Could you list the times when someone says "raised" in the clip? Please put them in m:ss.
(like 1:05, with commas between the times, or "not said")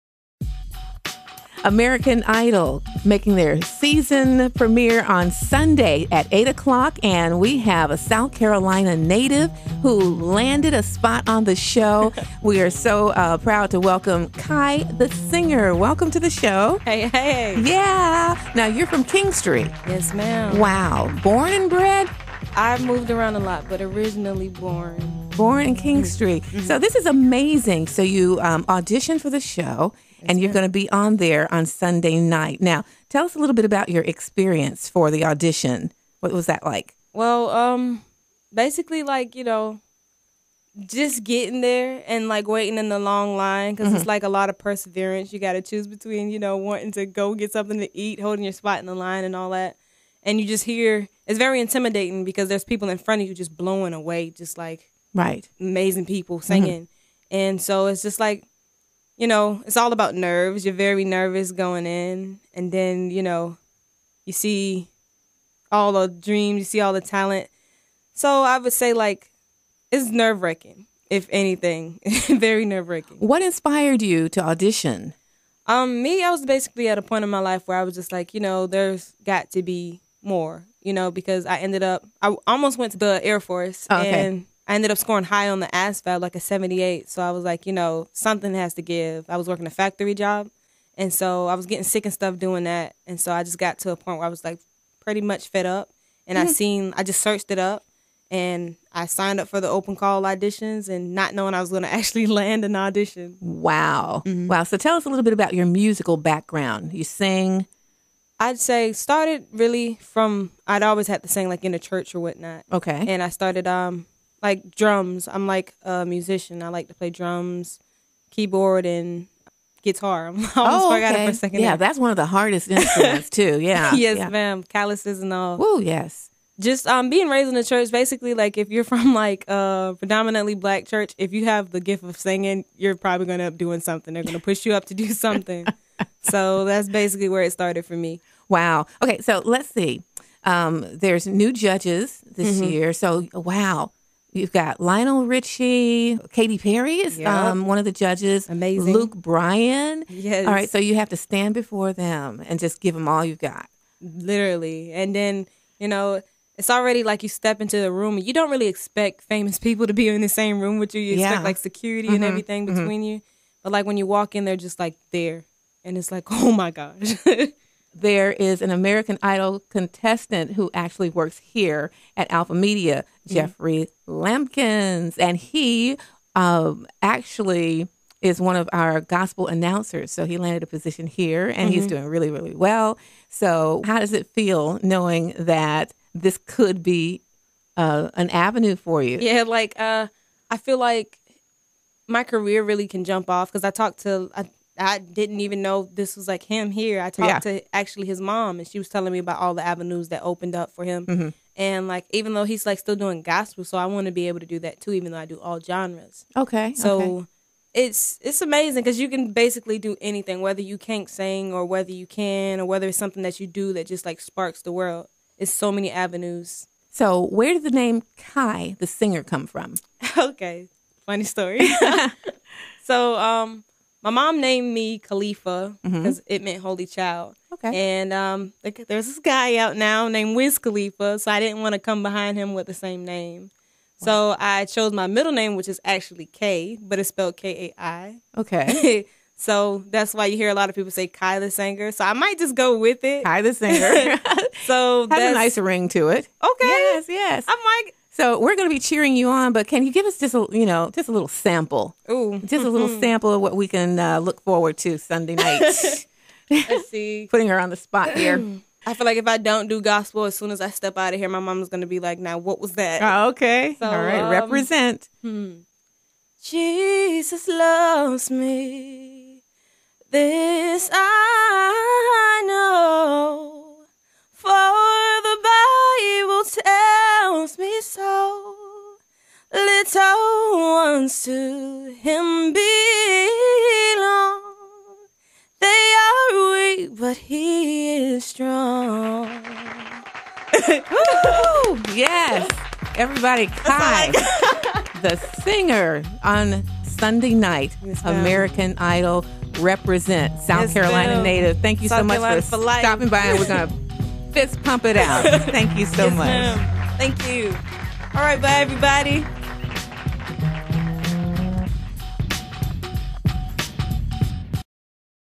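2:07.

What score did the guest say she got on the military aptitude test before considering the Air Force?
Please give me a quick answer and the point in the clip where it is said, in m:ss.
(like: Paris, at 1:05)
78, at 1:26.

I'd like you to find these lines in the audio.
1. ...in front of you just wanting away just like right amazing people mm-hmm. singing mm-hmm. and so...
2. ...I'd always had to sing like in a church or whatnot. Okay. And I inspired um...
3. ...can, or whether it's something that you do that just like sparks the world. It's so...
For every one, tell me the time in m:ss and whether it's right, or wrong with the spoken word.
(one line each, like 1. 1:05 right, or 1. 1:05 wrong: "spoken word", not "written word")
1. 0:52 wrong: "blowing", not "wanting"
2. 1:50 wrong: "started", not "inspired"
3. 3:32 right.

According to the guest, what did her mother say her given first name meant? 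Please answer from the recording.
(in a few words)
holy child.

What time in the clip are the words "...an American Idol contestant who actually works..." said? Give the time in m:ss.
2:48.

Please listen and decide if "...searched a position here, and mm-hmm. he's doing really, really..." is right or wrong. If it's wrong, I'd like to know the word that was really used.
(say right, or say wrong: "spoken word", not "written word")
wrong: "landed", not "searched".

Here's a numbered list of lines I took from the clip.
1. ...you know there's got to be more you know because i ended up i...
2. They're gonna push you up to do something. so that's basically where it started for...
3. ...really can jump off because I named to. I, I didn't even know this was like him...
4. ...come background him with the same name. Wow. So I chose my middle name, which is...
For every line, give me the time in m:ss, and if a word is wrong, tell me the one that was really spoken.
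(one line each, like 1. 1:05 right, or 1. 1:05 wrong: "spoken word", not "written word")
1. 1:18 right
2. 2:14 right
3. 3:12 wrong: "talked", not "named"
4. 3:51 wrong: "behind", not "background".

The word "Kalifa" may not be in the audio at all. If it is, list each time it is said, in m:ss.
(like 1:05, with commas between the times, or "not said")
3:44.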